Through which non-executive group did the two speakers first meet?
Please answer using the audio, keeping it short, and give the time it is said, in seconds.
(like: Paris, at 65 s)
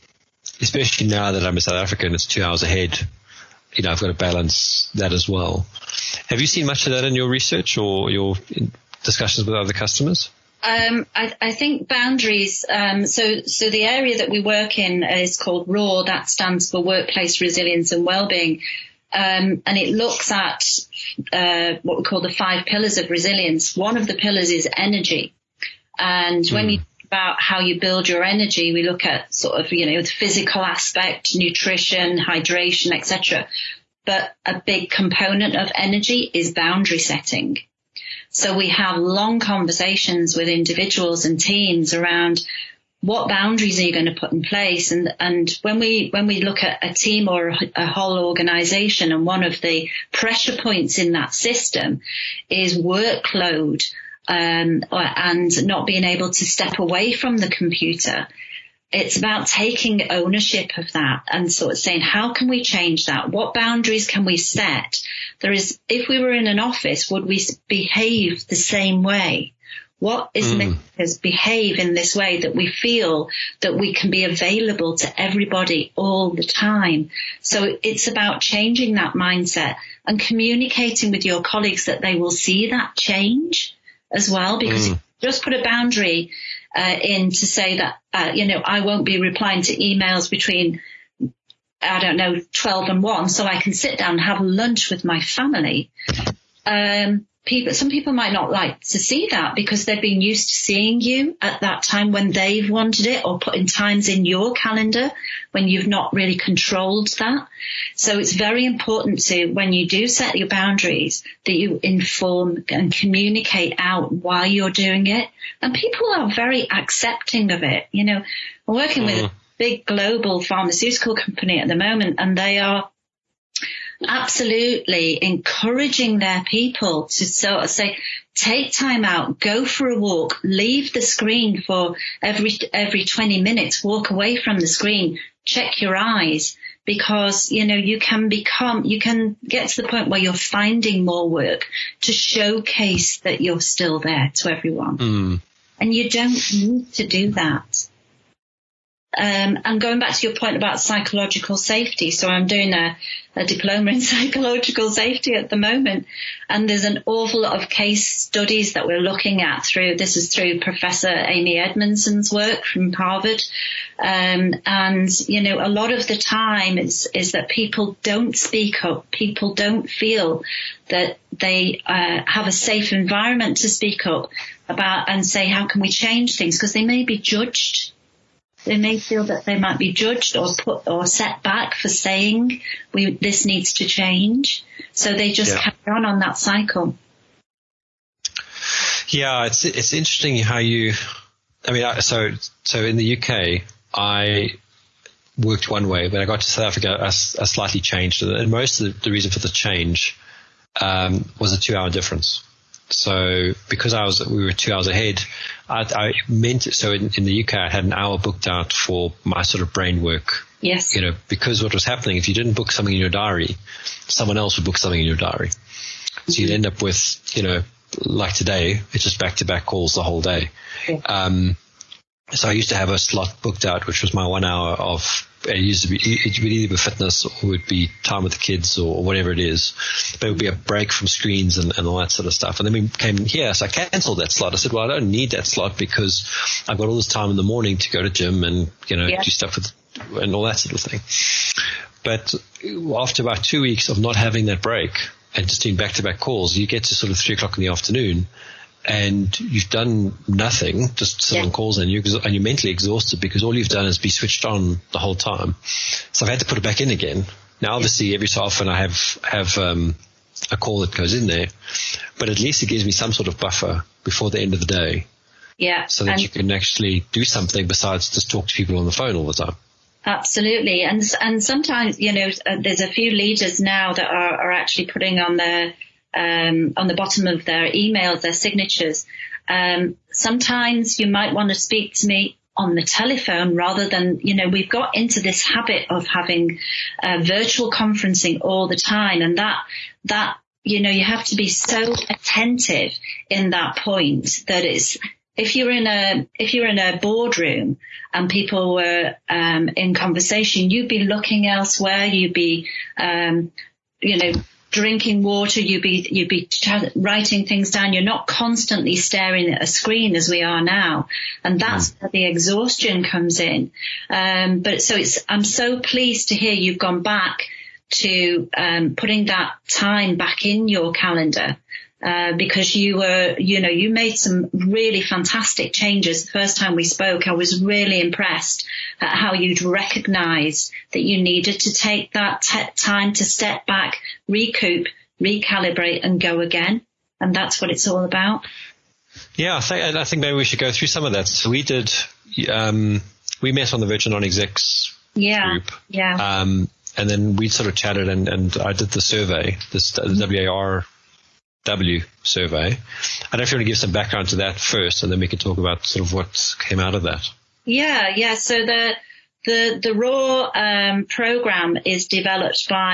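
Virgin Non-Execs, at 343 s.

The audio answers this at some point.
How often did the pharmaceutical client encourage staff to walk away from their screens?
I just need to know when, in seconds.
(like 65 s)
132 s.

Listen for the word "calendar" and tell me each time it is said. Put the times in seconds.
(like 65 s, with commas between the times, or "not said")
104 s, 320 s.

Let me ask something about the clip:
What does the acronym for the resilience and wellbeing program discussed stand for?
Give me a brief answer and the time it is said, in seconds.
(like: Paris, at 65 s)
Workplace Resilience and Wellbeing, at 16 s.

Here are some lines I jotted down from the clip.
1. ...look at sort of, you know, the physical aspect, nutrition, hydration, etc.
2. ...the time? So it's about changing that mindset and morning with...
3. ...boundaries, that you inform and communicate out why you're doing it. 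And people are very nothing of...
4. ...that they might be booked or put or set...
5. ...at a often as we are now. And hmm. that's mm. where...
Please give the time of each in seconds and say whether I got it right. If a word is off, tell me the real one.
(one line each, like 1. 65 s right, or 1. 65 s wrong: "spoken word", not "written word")
1. 28 s right
2. 76 s wrong: "communicating", not "morning"
3. 110 s wrong: "accepting", not "nothing"
4. 179 s wrong: "judged", not "booked"
5. 309 s wrong: "screen", not "often".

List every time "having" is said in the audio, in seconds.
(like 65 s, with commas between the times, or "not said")
244 s, 286 s.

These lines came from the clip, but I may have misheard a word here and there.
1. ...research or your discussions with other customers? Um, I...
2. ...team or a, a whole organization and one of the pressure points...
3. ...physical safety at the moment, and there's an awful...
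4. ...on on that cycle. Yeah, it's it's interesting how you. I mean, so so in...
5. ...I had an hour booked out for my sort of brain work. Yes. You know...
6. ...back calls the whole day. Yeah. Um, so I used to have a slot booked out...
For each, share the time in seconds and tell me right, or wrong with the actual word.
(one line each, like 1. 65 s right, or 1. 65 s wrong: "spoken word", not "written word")
1. 7 s right
2. 46 s right
3. 153 s wrong: "psychological", not "physical"
4. 185 s right
5. 207 s right
6. 219 s right.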